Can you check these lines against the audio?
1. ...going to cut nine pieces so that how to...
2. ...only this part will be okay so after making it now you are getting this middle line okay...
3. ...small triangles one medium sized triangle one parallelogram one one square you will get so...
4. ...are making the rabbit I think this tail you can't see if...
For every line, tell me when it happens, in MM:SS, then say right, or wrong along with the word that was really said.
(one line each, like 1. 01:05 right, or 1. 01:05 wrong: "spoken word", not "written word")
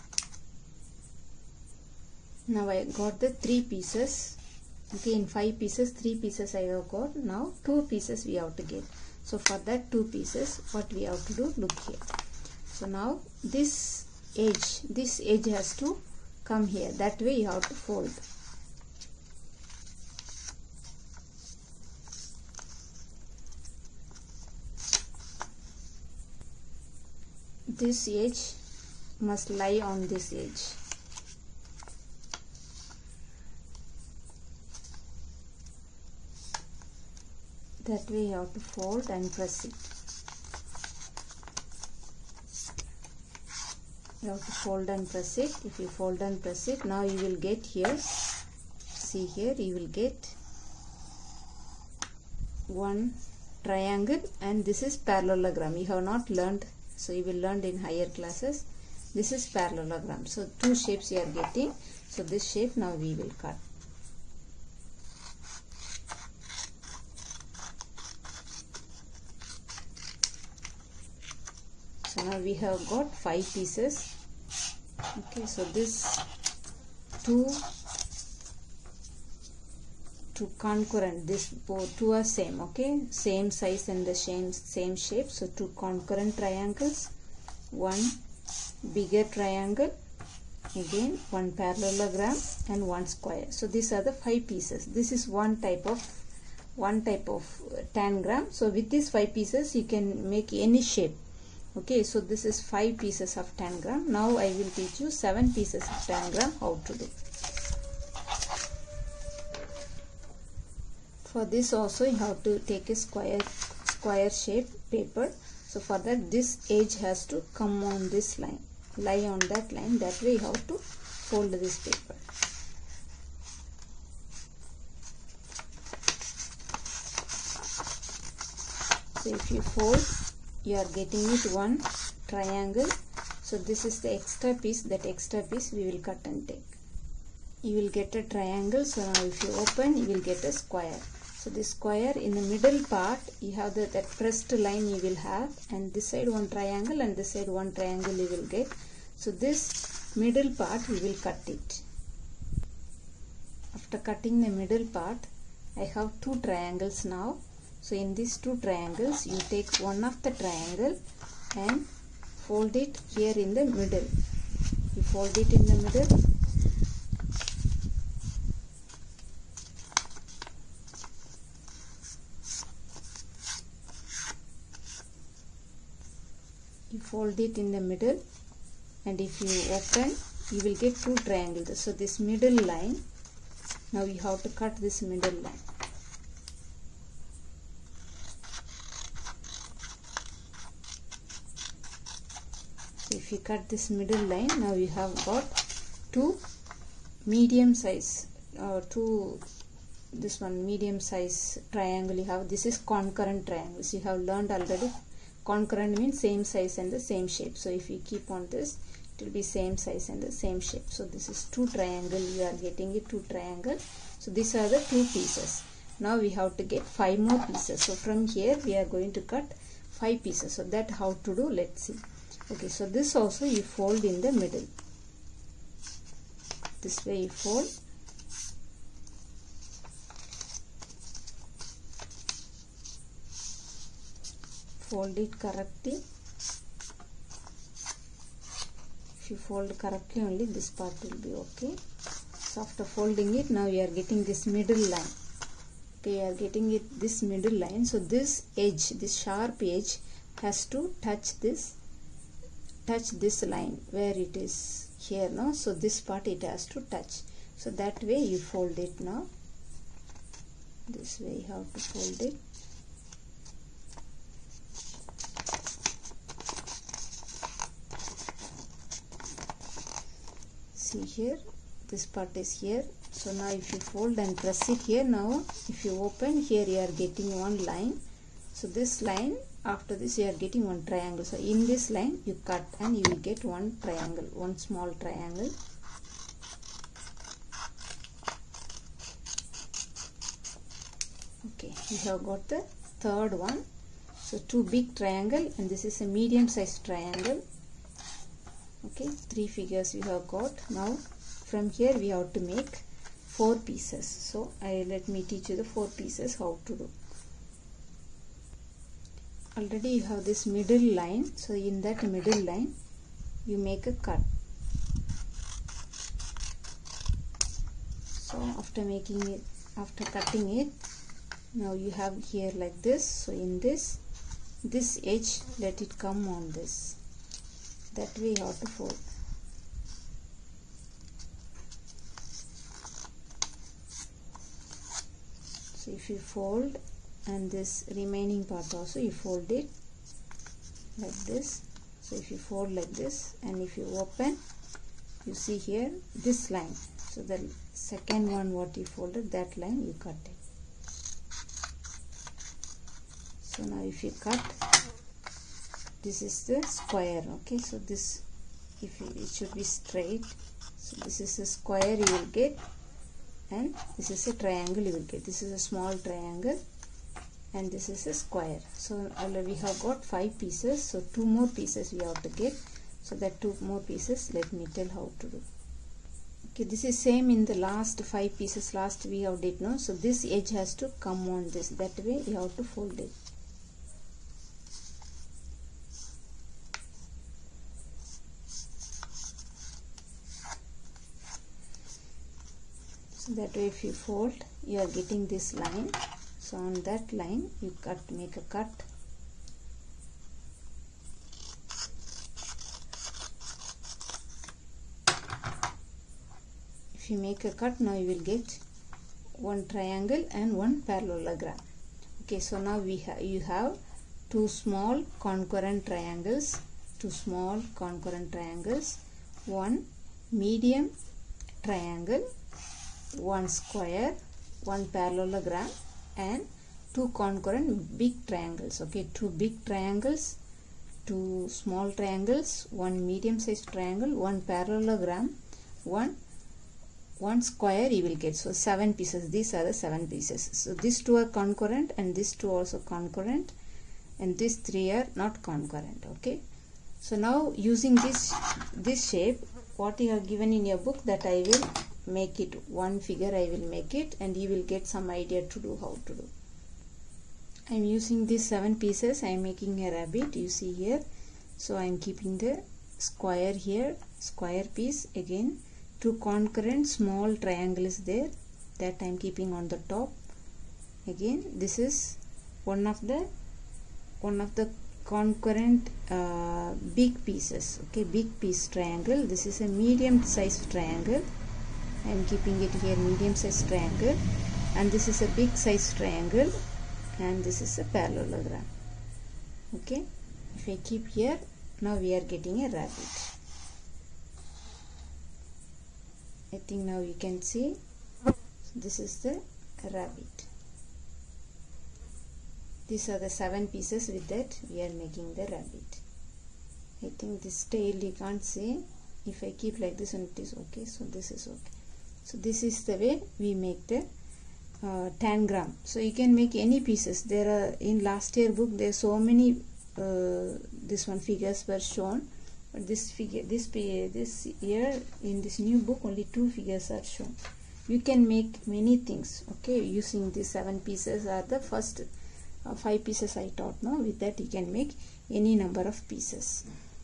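1. 03:38 wrong: "five", not "nine"
2. 04:00 wrong: "folding", not "making"
3. 07:11 right
4. 08:24 right.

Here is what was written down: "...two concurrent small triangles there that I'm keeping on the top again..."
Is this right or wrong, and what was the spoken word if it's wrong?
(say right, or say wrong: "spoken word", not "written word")
right.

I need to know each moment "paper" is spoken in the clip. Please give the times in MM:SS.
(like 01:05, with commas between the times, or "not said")
01:54, 02:01.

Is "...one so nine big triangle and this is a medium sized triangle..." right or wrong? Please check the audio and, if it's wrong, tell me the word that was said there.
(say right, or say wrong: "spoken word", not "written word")
wrong: "two", not "nine".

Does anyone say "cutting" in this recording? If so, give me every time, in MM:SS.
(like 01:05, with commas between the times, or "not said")
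02:33, 05:20.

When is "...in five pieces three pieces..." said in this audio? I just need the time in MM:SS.
00:05.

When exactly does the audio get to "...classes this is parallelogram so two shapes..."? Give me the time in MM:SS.
00:58.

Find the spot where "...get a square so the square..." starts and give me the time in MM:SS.
02:20.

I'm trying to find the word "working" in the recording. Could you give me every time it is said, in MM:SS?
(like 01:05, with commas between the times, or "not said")
not said.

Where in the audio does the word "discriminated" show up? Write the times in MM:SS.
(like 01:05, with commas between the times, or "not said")
not said.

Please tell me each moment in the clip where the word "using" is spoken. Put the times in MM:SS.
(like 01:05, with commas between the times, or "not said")
07:27, 07:37, 08:49.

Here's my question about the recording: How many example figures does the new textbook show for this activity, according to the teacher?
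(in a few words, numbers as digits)
2.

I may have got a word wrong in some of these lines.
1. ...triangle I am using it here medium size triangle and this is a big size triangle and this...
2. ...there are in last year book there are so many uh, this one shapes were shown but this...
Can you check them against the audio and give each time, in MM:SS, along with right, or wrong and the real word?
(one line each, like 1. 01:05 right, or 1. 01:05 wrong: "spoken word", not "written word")
1. 08:00 wrong: "keeping", not "using"
2. 08:37 wrong: "figures", not "shapes".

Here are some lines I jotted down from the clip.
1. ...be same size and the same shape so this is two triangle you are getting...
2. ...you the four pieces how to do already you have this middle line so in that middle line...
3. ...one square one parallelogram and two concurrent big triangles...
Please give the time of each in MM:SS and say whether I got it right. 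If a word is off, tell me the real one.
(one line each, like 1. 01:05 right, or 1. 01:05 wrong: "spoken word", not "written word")
1. 03:29 right
2. 05:05 right
3. 07:03 right.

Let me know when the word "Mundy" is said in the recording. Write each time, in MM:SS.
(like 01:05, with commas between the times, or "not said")
not said.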